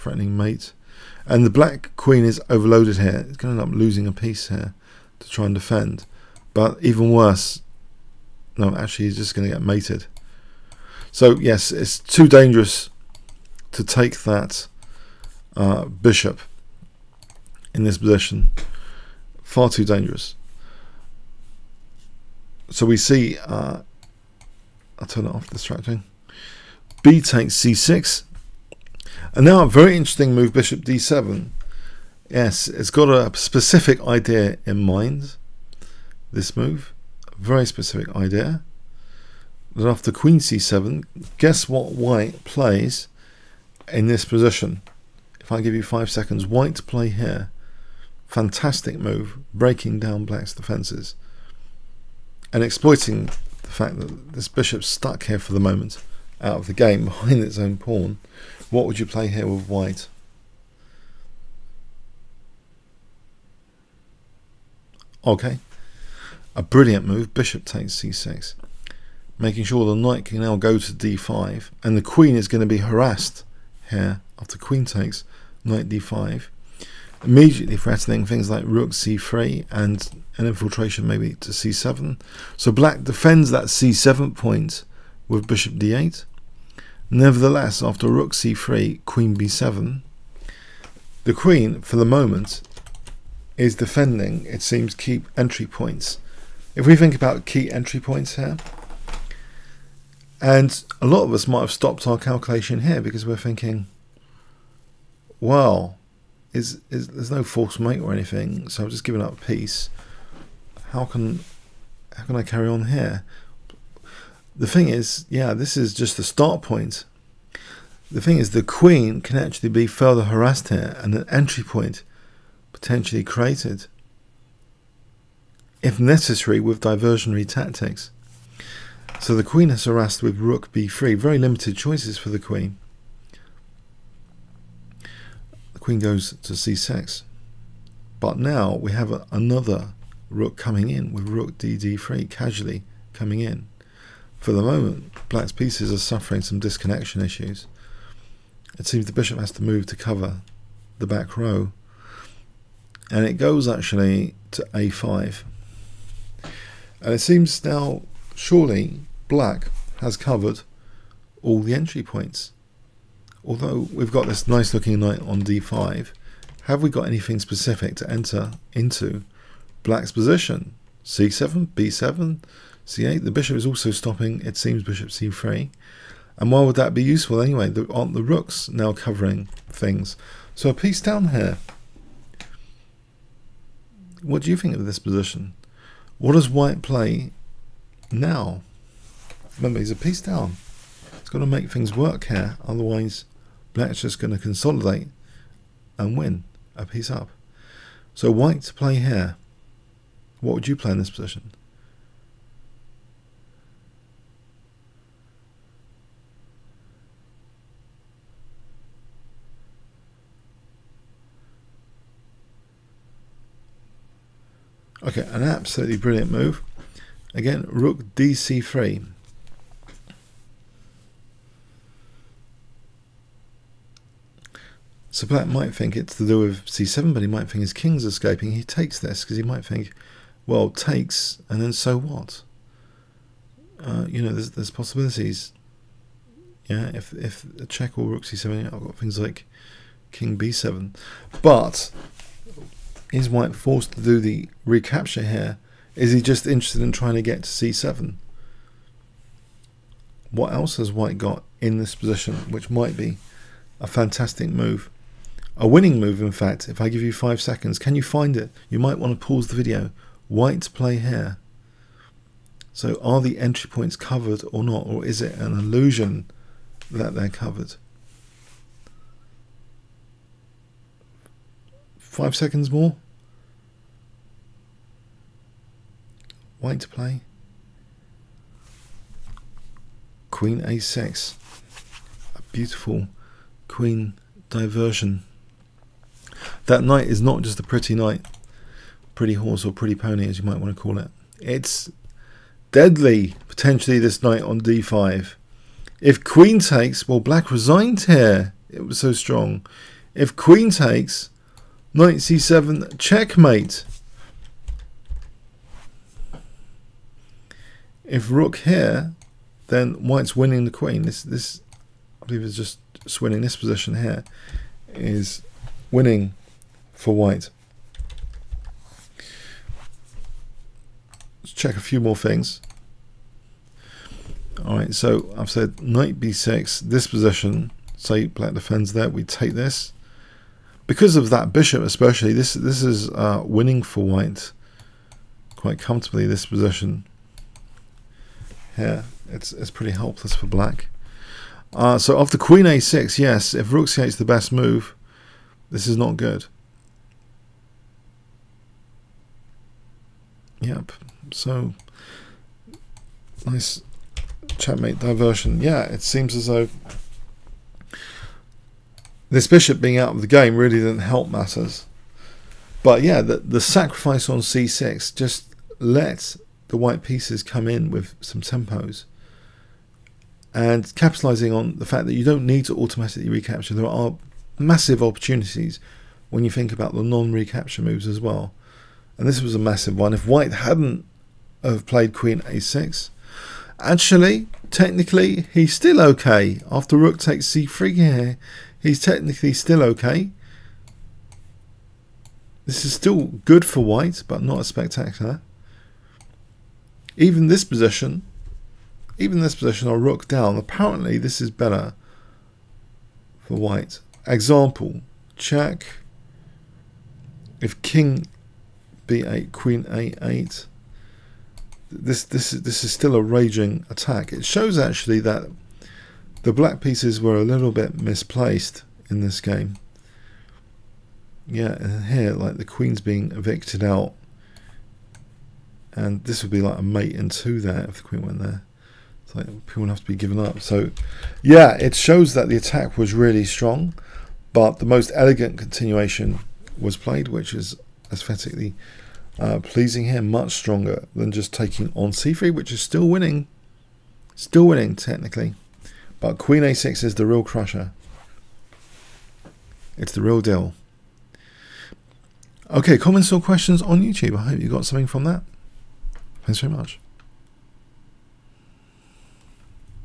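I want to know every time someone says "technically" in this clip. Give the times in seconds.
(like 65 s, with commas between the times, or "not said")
384 s, 389 s, 444 s.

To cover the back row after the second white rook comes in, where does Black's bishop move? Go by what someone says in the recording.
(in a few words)
a5.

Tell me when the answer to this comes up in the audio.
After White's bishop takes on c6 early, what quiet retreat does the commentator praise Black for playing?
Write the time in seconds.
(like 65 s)
30 s.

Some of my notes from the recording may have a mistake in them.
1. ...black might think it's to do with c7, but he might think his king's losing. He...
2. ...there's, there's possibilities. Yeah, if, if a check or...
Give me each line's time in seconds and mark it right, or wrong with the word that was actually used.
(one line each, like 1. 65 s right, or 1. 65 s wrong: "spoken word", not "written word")
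1. 225 s wrong: "escaping", not "losing"
2. 234 s right.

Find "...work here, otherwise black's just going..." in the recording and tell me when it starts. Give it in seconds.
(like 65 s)
191 s.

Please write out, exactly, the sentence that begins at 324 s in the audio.
All right, so I've said knight b6, this position, say black defends there, we take this.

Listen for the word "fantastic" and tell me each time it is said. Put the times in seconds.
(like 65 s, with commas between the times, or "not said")
48 s, 253 s.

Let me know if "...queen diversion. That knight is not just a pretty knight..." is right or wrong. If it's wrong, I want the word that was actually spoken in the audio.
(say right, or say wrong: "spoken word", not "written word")
right.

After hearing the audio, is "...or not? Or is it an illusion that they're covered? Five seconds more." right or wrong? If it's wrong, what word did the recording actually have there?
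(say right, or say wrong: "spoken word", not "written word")
right.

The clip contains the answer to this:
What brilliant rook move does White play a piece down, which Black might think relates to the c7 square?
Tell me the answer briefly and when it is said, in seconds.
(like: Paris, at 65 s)
Rook dc3, at 218 s.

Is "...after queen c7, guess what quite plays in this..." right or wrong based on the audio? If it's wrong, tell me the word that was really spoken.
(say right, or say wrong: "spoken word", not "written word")
wrong: "white", not "quite".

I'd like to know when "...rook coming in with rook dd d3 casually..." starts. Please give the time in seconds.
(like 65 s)
140 s.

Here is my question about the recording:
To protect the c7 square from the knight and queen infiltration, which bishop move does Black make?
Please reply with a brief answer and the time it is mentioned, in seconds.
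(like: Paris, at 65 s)
Bishop d8, at 85 s.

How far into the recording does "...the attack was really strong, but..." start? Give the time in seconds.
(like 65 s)
432 s.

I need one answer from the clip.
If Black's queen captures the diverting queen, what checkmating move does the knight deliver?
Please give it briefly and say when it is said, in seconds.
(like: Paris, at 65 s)
Knight c7, at 301 s.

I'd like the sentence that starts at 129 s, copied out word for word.
So the queen has harassed with rook b3.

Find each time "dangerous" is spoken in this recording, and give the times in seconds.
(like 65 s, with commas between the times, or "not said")
12 s, 19 s.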